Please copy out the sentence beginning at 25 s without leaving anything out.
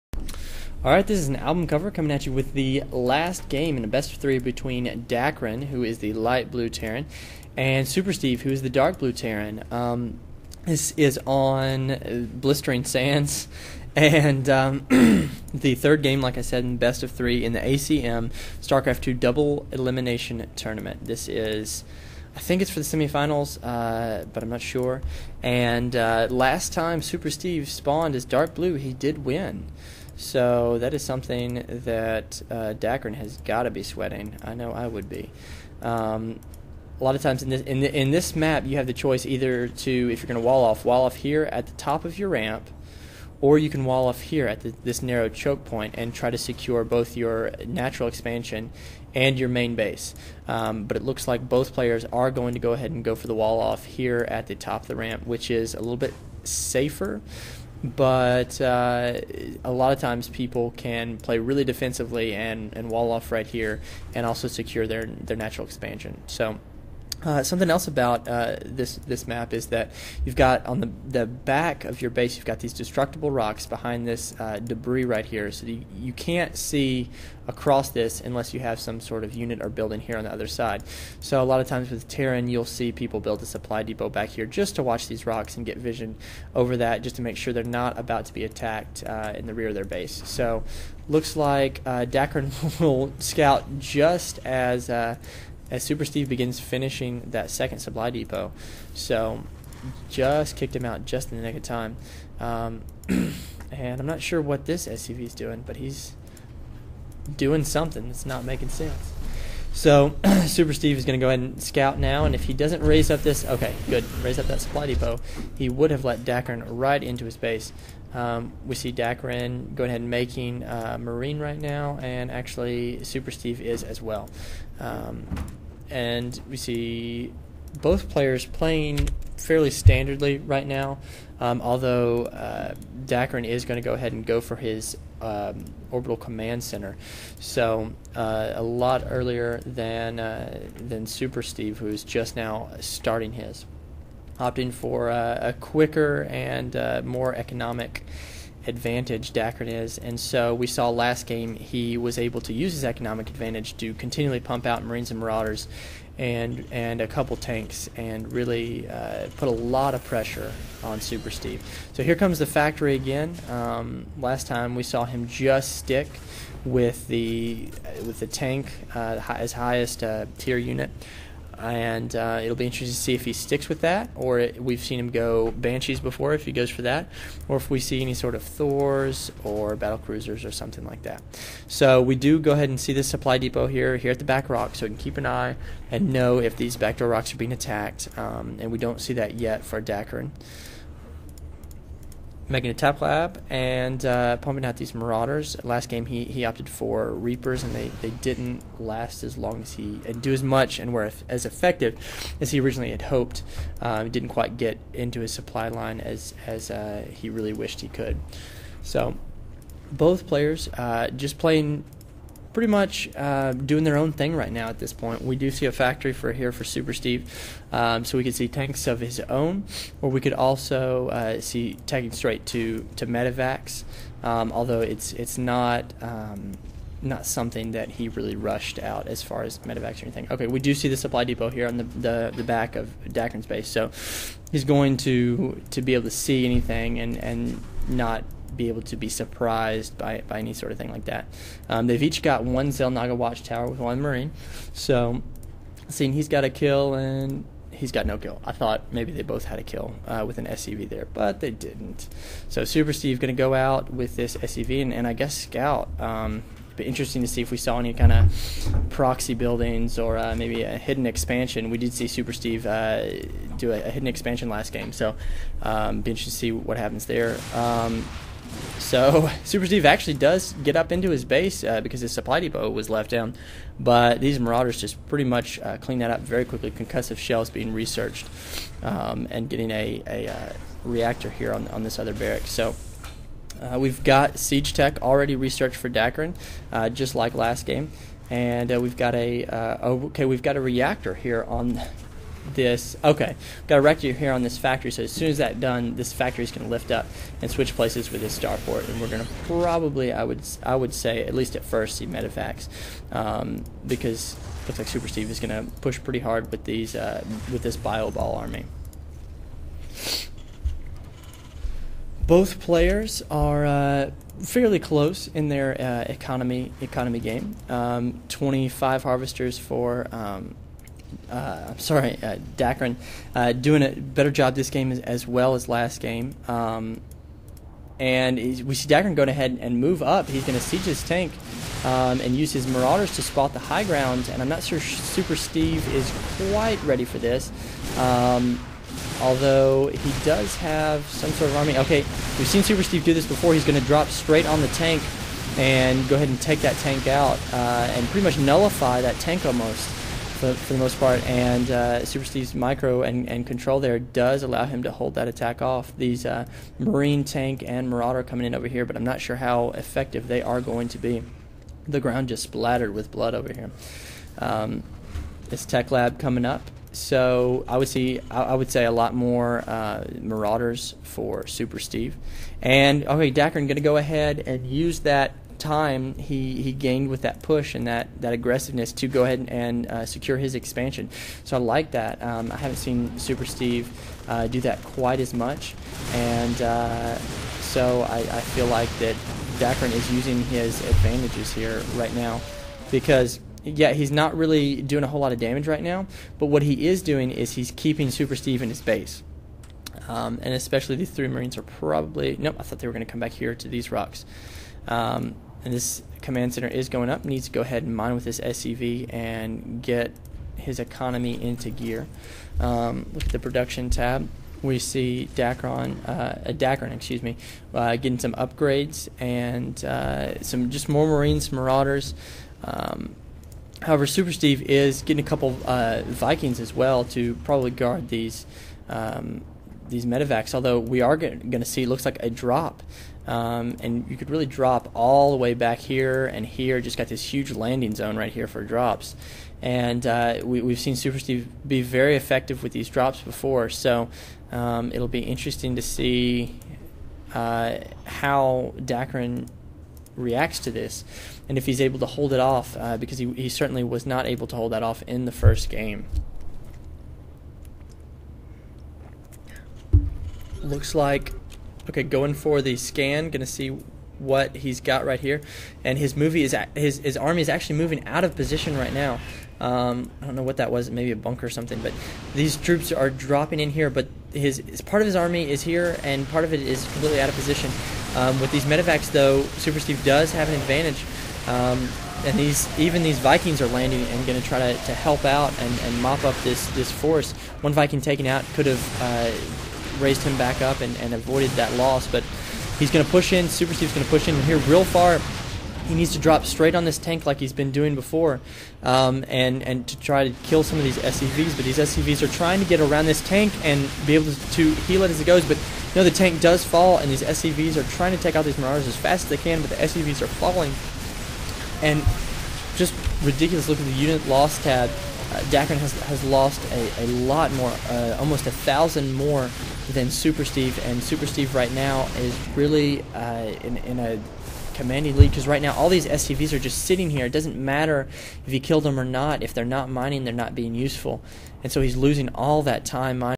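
And uh, last time Super Steve spawned as Dark Blue, he did win.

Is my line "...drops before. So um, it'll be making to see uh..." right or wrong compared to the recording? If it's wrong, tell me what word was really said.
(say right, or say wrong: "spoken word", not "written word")
wrong: "interesting", not "making".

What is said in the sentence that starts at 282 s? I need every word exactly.
So uh, we've got Siege Tech already researched for Dakrin, uh, just like last game.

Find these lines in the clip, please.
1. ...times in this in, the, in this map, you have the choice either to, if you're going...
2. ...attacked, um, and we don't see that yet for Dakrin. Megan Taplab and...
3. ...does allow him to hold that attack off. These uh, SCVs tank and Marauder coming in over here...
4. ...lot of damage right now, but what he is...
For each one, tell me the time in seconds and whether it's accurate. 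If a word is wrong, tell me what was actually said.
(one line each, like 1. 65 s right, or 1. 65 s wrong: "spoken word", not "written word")
1. 37 s right
2. 187 s right
3. 353 s wrong: "Marine", not "SCVs"
4. 395 s right.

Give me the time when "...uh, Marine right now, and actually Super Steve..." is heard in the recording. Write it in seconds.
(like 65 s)
120 s.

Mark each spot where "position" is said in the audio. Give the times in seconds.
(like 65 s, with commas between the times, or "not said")
468 s, 477 s.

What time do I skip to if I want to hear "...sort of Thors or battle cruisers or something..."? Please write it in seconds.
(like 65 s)
178 s.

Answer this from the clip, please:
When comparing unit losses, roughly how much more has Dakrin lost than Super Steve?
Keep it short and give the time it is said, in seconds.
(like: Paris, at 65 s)
Almost a thousand, at 518 s.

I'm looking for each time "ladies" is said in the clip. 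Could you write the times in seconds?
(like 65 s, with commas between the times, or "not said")
not said.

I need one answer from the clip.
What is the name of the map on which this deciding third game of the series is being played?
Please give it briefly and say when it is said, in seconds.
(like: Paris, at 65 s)
Blistering Sands, at 12 s.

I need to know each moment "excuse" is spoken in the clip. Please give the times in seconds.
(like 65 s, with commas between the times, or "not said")
416 s.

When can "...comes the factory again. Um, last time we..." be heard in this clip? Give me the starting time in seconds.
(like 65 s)
162 s.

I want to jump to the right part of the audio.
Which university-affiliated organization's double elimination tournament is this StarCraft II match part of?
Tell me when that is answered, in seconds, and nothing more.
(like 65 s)
17 s.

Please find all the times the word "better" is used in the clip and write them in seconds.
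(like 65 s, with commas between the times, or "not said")
323 s.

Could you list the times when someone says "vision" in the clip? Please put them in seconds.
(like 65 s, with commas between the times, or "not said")
85 s.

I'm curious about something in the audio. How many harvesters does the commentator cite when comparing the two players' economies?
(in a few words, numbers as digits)
25.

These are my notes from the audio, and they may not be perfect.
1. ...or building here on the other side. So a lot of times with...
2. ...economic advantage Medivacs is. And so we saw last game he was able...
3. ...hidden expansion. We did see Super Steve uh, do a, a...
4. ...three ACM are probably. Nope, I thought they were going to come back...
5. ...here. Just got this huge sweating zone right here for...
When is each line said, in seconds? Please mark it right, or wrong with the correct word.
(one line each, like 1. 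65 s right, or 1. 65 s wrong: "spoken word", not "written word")
1. 79 s right
2. 147 s wrong: "Dakrin", not "Medivacs"
3. 260 s right
4. 401 s wrong: "Marines", not "ACM"
5. 436 s wrong: "landing", not "sweating".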